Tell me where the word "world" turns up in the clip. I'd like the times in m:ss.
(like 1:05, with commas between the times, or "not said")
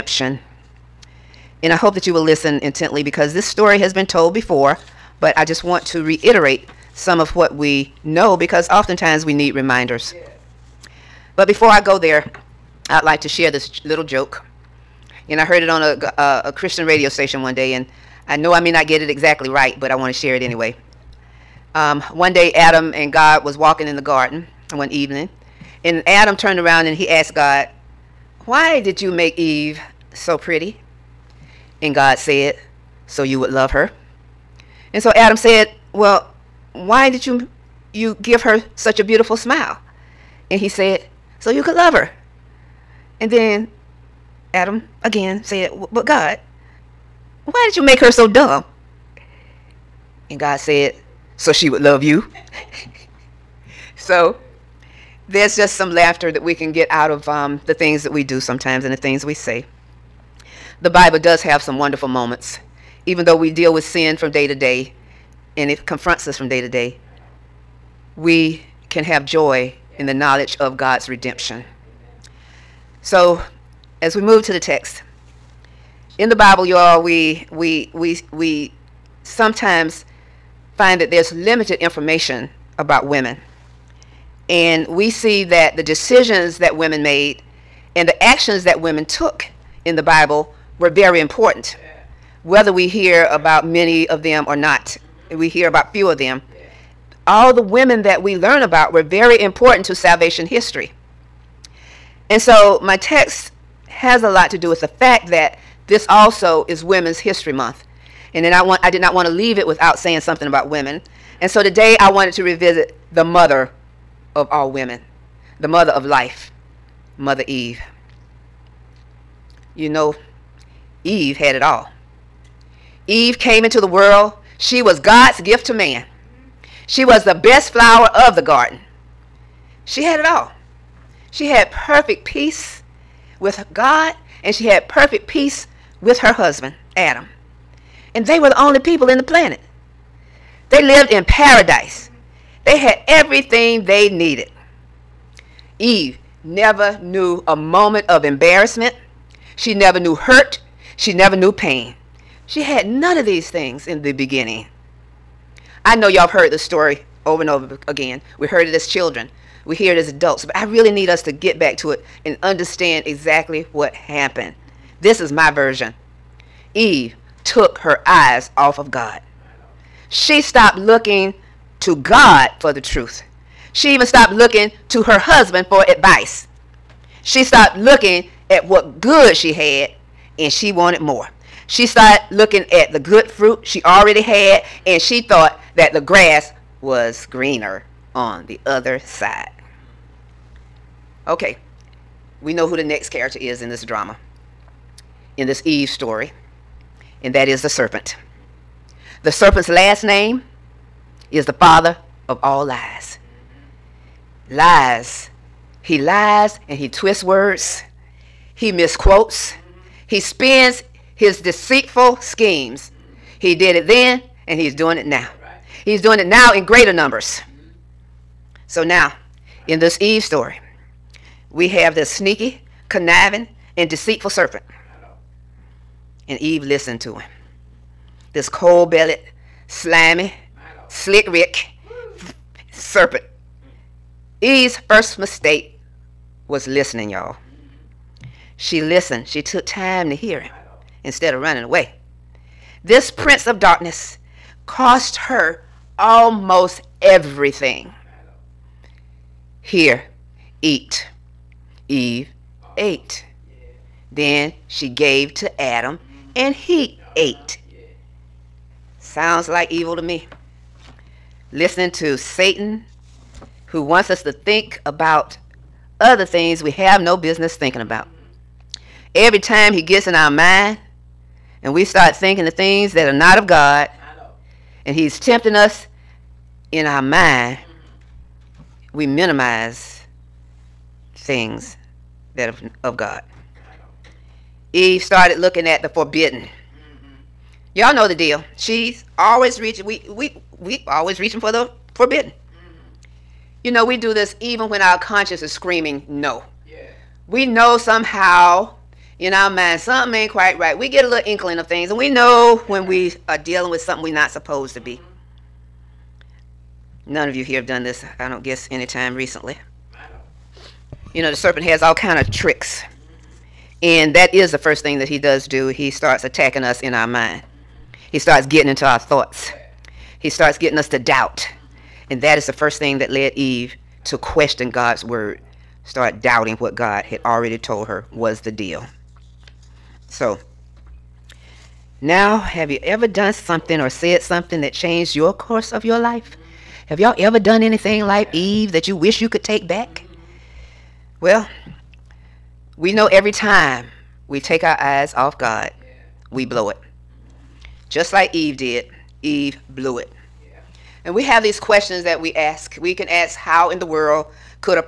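2:03, 5:53.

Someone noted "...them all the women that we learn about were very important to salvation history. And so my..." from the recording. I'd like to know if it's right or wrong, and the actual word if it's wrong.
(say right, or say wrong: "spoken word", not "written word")
right.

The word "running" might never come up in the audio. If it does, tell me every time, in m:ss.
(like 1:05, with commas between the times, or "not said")
4:01.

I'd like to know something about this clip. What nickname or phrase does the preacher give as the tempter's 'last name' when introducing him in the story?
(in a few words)
father of all lies.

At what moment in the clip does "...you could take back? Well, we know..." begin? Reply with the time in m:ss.
5:39.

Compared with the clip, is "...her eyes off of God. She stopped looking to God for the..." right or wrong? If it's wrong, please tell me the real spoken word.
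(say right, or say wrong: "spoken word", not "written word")
right.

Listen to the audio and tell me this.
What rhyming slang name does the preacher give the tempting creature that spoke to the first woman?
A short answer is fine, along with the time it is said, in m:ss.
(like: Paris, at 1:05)
slick Rick, at 3:50.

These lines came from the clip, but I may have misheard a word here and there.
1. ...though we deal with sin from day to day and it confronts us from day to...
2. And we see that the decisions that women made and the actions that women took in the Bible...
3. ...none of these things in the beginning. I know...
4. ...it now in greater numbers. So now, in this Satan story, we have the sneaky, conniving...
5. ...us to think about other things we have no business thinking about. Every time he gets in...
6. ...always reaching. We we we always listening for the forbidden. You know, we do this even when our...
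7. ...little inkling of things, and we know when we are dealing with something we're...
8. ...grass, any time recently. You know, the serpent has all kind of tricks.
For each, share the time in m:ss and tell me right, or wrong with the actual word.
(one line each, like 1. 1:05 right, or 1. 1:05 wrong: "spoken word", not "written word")
1. 1:03 right
2. 1:24 right
3. 2:32 right
4. 3:36 wrong: "Eve", not "Satan"
5. 4:24 right
6. 4:49 wrong: "reaching", not "listening"
7. 5:01 right
8. 5:08 wrong: "guess", not "grass".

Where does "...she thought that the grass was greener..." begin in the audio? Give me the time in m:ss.
3:05.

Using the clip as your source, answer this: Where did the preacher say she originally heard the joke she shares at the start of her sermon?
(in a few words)
Christian radio station.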